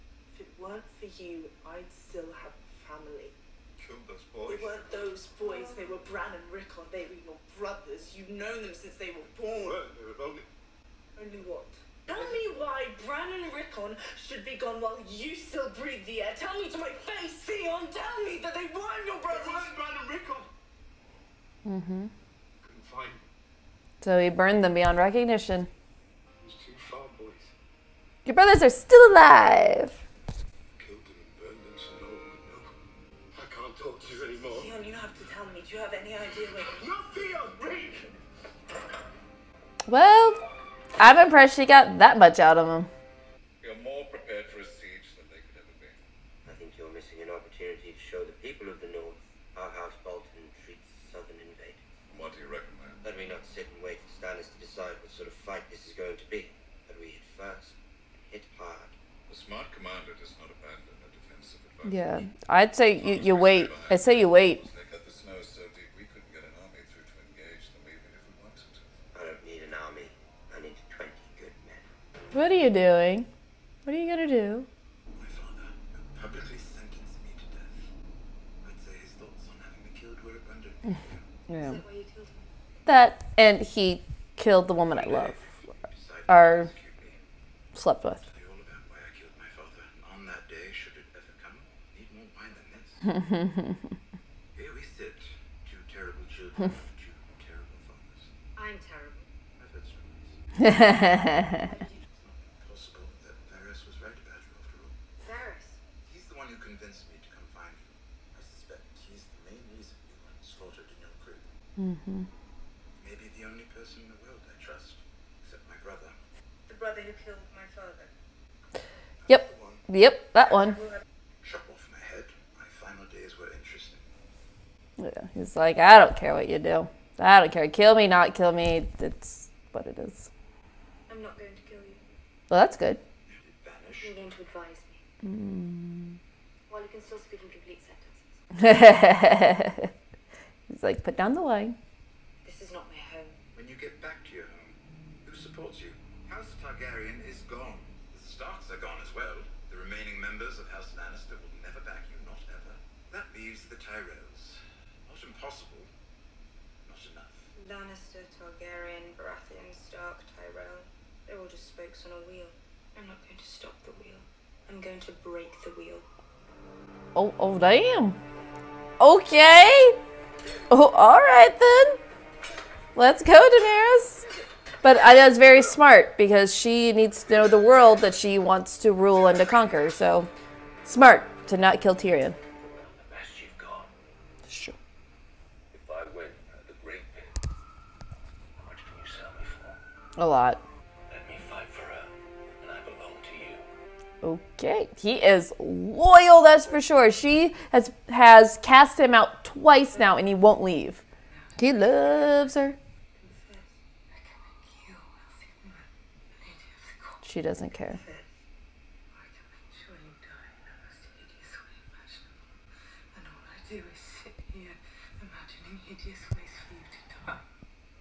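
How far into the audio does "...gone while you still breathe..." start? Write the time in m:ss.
0:14.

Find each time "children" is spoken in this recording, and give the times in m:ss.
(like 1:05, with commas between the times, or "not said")
1:36.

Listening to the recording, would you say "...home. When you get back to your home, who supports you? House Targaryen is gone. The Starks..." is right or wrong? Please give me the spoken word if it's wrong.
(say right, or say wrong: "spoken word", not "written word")
right.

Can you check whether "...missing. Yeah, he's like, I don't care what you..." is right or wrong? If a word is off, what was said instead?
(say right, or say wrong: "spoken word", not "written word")
wrong: "interesting", not "missing".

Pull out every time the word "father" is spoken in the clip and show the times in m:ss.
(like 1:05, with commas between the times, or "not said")
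1:15, 1:37, 1:57.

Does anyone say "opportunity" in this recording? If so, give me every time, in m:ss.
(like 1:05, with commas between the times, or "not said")
0:47.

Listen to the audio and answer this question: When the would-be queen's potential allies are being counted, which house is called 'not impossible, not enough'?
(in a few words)
Tyrells.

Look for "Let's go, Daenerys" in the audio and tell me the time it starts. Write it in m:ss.
2:52.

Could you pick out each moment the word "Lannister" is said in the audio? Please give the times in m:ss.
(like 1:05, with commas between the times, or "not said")
2:30, 2:37.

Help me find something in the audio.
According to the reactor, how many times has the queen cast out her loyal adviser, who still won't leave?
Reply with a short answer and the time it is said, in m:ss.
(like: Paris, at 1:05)
2, at 3:19.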